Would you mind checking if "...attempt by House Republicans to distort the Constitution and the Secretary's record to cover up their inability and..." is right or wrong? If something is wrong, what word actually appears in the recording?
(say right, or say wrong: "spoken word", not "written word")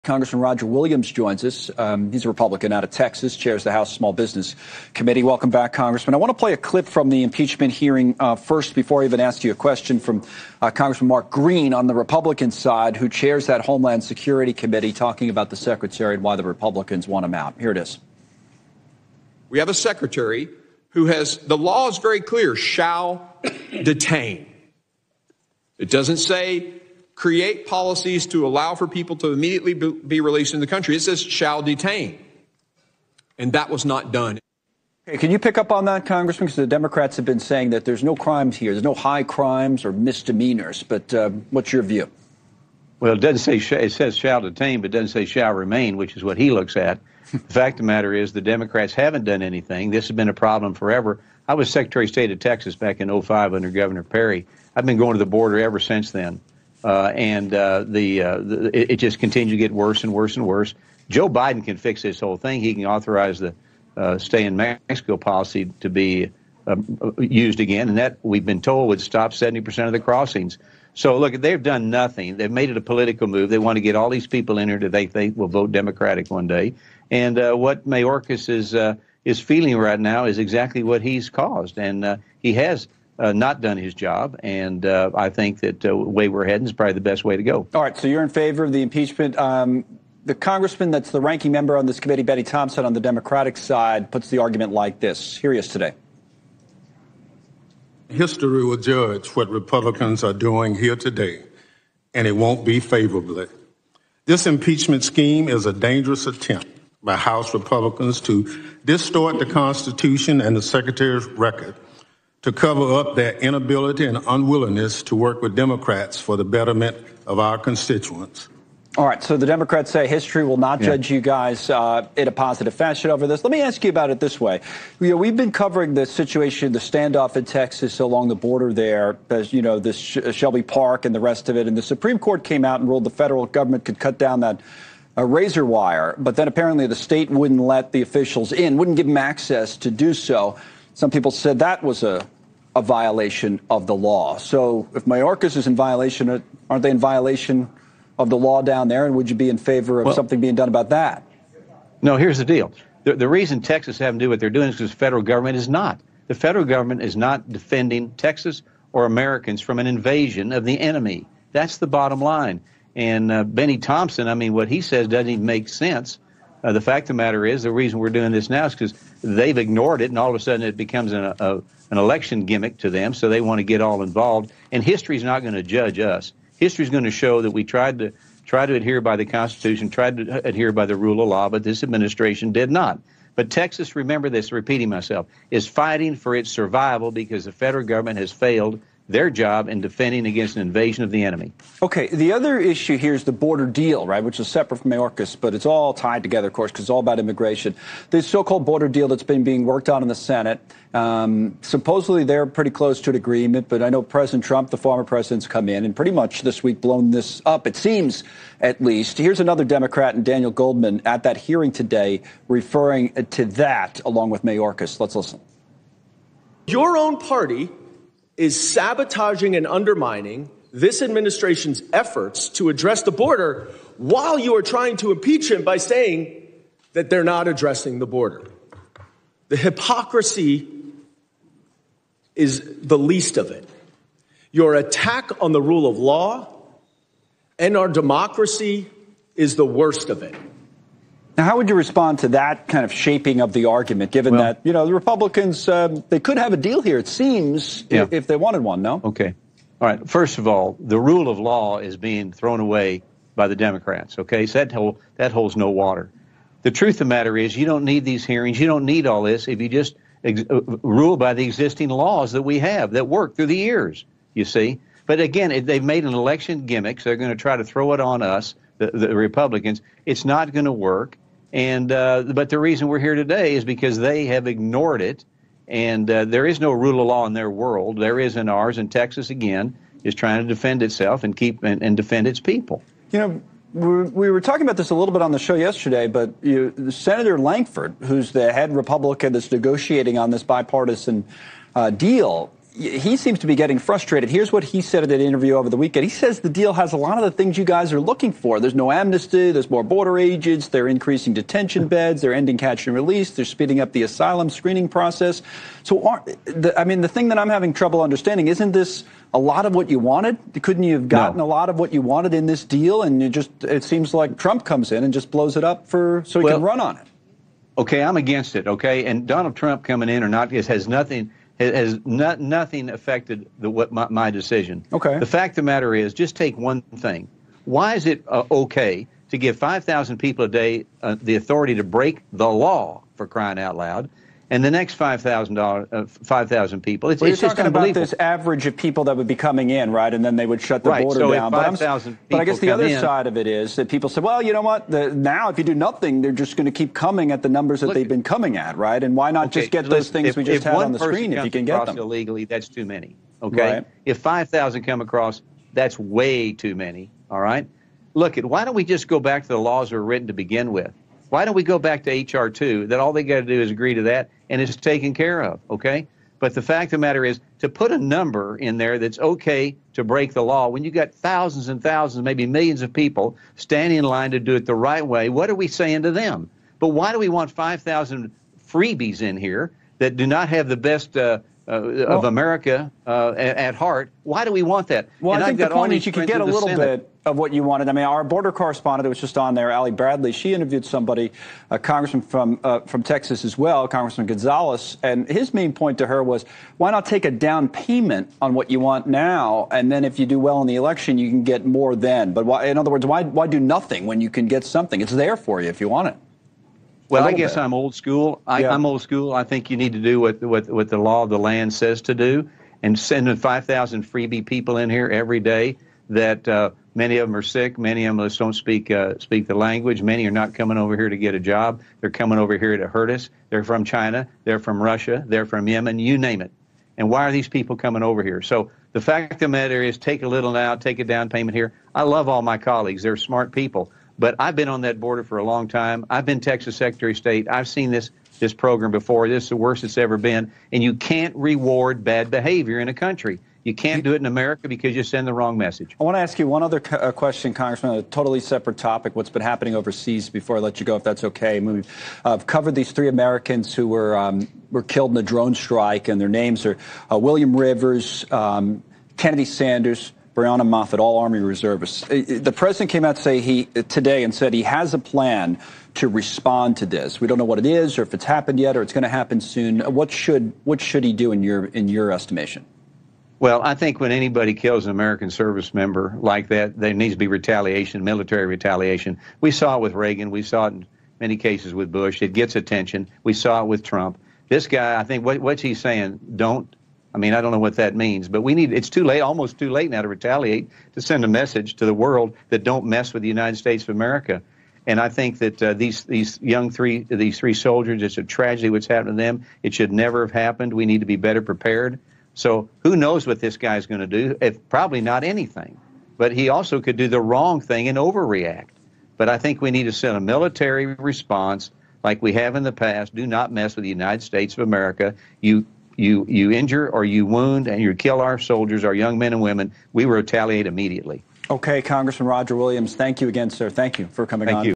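right.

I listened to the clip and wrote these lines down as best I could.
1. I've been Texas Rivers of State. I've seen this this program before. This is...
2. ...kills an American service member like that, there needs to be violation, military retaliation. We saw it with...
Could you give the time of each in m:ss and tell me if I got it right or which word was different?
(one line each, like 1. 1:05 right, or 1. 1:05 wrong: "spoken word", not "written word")
1. 7:16 wrong: "Secretary", not "Rivers"
2. 7:54 wrong: "retaliation", not "violation".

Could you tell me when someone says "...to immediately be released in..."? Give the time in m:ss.
0:29.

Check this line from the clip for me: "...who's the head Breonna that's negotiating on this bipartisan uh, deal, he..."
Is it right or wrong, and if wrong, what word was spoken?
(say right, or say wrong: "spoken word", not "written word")
wrong: "Republican", not "Breonna".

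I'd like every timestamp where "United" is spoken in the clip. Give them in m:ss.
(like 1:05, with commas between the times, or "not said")
8:13, 8:33.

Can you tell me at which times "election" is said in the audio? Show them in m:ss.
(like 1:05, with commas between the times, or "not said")
2:51, 4:26, 6:40.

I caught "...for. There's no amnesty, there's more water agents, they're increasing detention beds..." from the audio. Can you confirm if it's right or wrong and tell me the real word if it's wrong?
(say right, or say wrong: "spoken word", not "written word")
wrong: "border", not "water".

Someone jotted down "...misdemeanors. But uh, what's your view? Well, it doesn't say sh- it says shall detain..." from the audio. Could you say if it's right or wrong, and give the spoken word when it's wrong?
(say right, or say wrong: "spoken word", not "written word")
right.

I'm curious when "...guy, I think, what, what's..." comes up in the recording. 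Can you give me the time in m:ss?
8:04.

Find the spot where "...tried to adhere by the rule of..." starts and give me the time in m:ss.
2:59.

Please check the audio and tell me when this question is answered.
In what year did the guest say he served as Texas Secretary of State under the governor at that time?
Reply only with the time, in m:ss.
0:53.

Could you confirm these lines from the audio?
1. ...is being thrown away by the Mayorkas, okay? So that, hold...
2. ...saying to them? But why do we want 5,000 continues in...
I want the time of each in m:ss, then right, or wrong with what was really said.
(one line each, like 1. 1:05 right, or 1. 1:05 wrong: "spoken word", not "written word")
1. 4:11 wrong: "Democrats", not "Mayorkas"
2. 6:15 wrong: "freebies", not "continues".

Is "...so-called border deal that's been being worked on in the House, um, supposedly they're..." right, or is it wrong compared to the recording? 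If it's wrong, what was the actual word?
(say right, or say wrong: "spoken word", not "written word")
wrong: "Senate", not "House".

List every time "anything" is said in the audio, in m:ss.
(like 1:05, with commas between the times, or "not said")
0:49, 8:25.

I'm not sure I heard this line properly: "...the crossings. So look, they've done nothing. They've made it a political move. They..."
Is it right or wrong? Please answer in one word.
right.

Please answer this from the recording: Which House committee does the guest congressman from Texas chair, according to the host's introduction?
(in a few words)
Small Business Committee.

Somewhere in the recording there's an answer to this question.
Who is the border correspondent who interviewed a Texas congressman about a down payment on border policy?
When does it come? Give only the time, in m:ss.
6:29.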